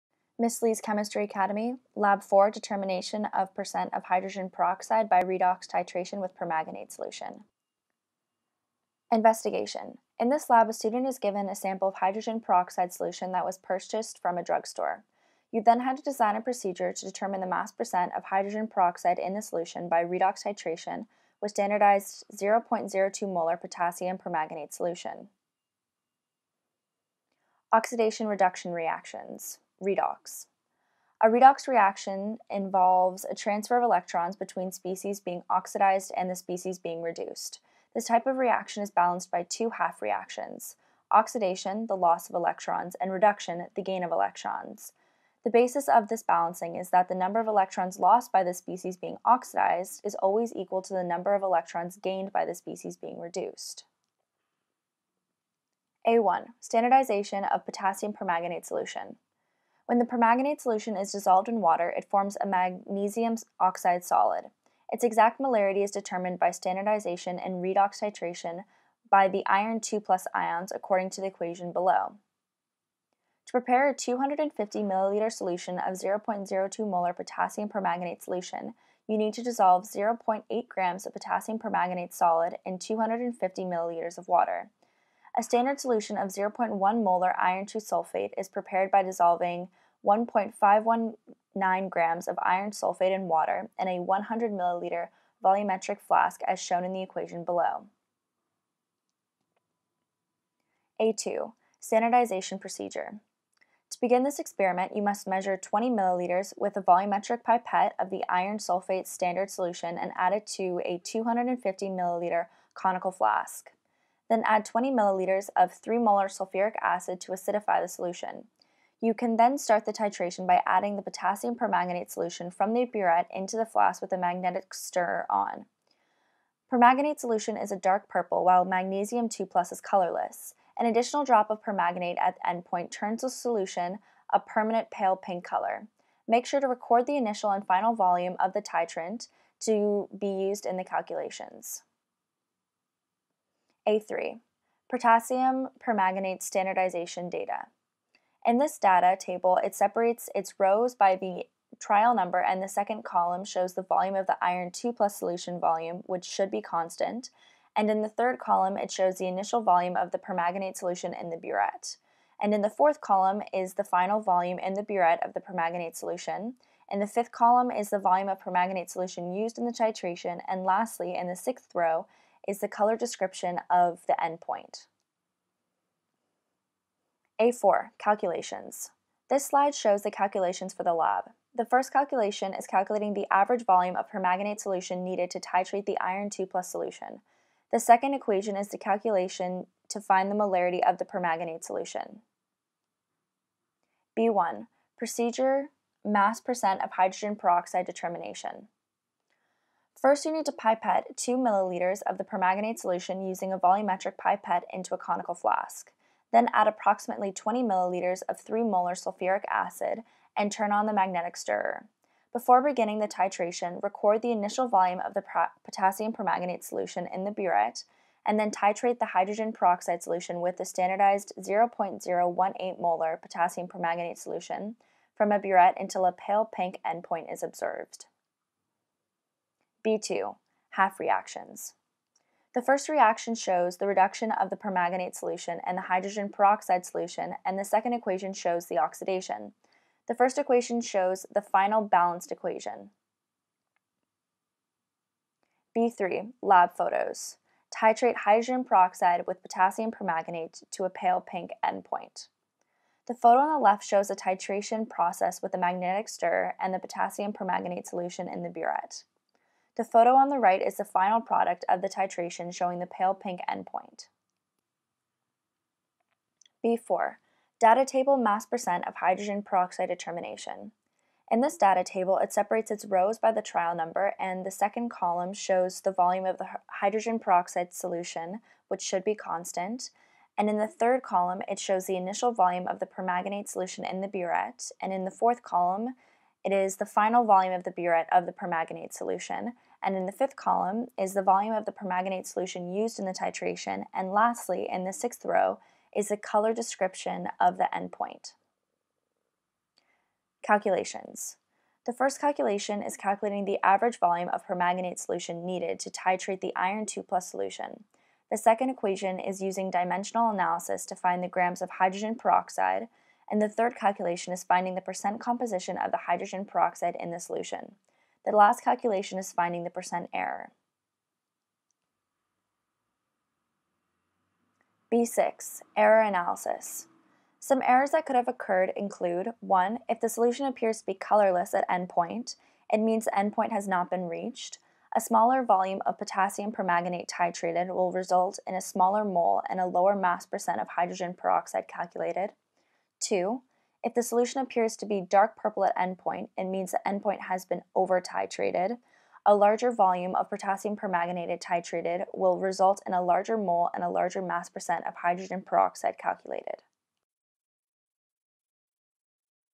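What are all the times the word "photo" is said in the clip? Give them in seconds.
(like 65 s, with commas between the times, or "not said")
246 s, 253 s, 259 s.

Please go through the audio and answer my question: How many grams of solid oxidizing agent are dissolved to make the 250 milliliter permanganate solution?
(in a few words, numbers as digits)
0.8 grams.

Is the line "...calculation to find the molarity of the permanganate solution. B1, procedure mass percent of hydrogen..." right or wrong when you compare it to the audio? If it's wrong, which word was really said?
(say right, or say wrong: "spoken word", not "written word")
right.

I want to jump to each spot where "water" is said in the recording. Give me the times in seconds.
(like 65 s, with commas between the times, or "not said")
61 s, 84 s, 93 s.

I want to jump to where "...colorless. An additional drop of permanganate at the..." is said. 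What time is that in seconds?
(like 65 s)
129 s.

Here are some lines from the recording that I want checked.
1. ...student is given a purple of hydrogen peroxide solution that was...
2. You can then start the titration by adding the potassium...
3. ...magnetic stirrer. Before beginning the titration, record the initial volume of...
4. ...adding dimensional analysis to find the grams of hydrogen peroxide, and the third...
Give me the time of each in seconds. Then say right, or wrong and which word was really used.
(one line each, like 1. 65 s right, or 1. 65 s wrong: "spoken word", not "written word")
1. 10 s wrong: "sample", not "purple"
2. 119 s right
3. 210 s right
4. 309 s wrong: "using", not "adding".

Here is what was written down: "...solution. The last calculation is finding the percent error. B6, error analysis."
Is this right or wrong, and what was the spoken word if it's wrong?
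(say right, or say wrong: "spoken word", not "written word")
right.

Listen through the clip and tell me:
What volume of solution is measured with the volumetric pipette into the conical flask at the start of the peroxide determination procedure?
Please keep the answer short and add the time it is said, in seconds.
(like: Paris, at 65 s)
2 milliliters, at 201 s.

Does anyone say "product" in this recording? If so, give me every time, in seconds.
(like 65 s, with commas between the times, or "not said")
261 s.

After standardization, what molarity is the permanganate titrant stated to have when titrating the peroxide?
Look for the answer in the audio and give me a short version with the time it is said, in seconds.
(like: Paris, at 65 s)
0.018 molar, at 221 s.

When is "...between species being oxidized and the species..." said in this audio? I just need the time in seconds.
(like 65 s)
34 s.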